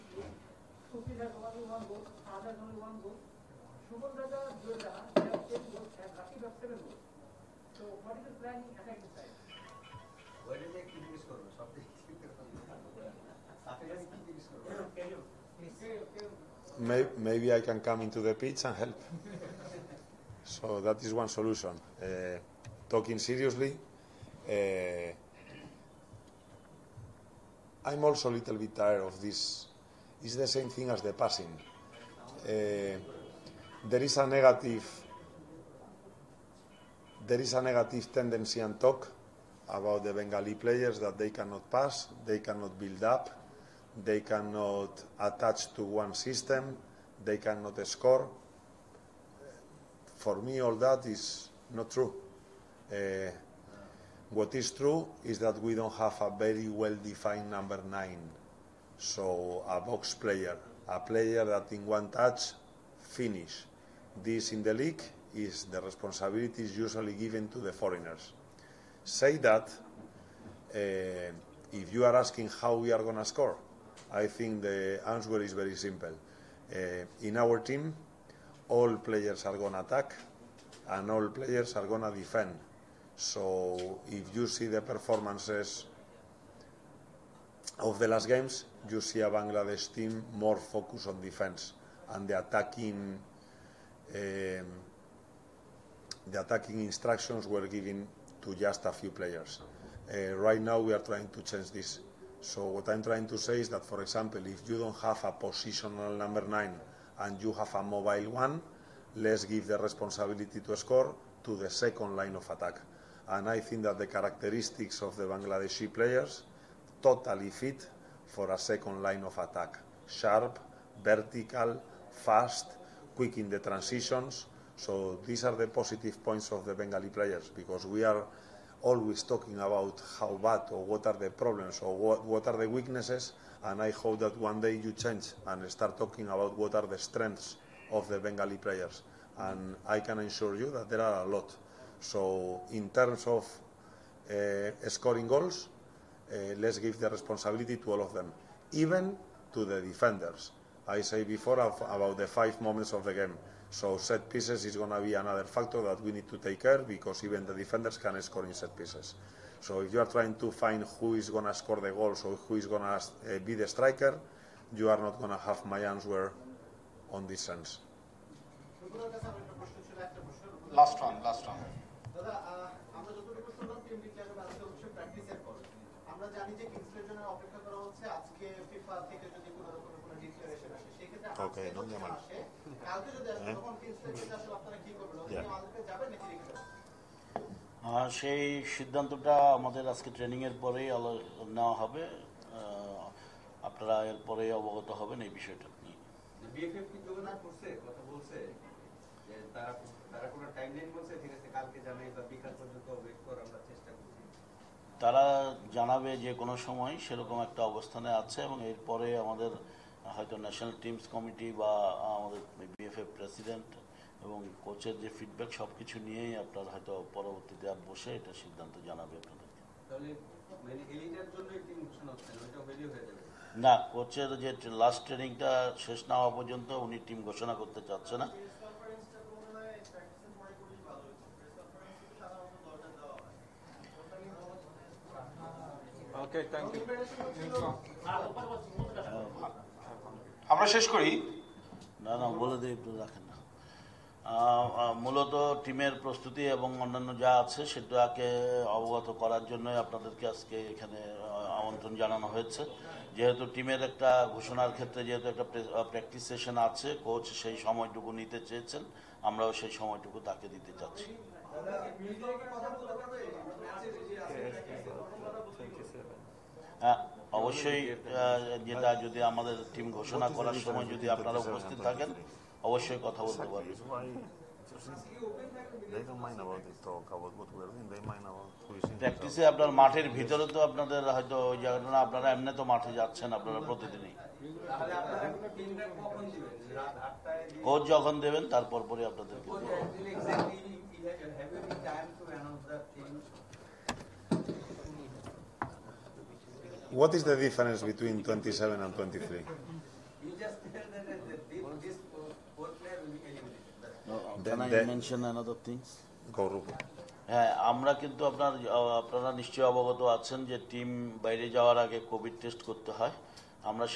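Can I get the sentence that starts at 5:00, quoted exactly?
You just tell that this uh, four player will be eliminated.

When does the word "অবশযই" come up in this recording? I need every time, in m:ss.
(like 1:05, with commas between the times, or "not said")
4:27, 4:32.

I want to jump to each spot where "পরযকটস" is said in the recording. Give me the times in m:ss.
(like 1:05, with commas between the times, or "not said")
4:15, 4:38.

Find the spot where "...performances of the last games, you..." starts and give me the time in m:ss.
1:24.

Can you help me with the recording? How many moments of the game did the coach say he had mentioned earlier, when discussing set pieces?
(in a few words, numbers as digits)
5.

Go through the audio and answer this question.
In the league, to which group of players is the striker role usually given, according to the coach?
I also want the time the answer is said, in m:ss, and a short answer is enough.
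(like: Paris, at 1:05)
the foreigners, at 1:07.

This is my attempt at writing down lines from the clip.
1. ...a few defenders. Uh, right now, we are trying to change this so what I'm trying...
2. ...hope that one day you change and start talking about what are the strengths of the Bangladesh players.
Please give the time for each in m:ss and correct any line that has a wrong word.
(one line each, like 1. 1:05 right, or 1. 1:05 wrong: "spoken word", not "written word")
1. 1:38 wrong: "players", not "defenders"
2. 2:13 wrong: "Bengali", not "Bangladesh".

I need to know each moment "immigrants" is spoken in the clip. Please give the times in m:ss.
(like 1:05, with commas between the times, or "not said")
not said.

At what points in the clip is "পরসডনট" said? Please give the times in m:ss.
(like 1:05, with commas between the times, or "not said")
3:33.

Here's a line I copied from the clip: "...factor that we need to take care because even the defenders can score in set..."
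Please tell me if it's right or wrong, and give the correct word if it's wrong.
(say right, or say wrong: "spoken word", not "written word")
right.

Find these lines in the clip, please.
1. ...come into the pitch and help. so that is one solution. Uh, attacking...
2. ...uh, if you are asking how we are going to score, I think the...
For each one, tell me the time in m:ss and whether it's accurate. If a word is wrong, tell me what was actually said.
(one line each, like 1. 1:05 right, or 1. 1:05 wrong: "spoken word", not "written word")
1. 0:17 wrong: "talking", not "attacking"
2. 1:10 right.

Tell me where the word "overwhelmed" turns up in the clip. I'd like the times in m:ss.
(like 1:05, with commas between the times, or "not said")
not said.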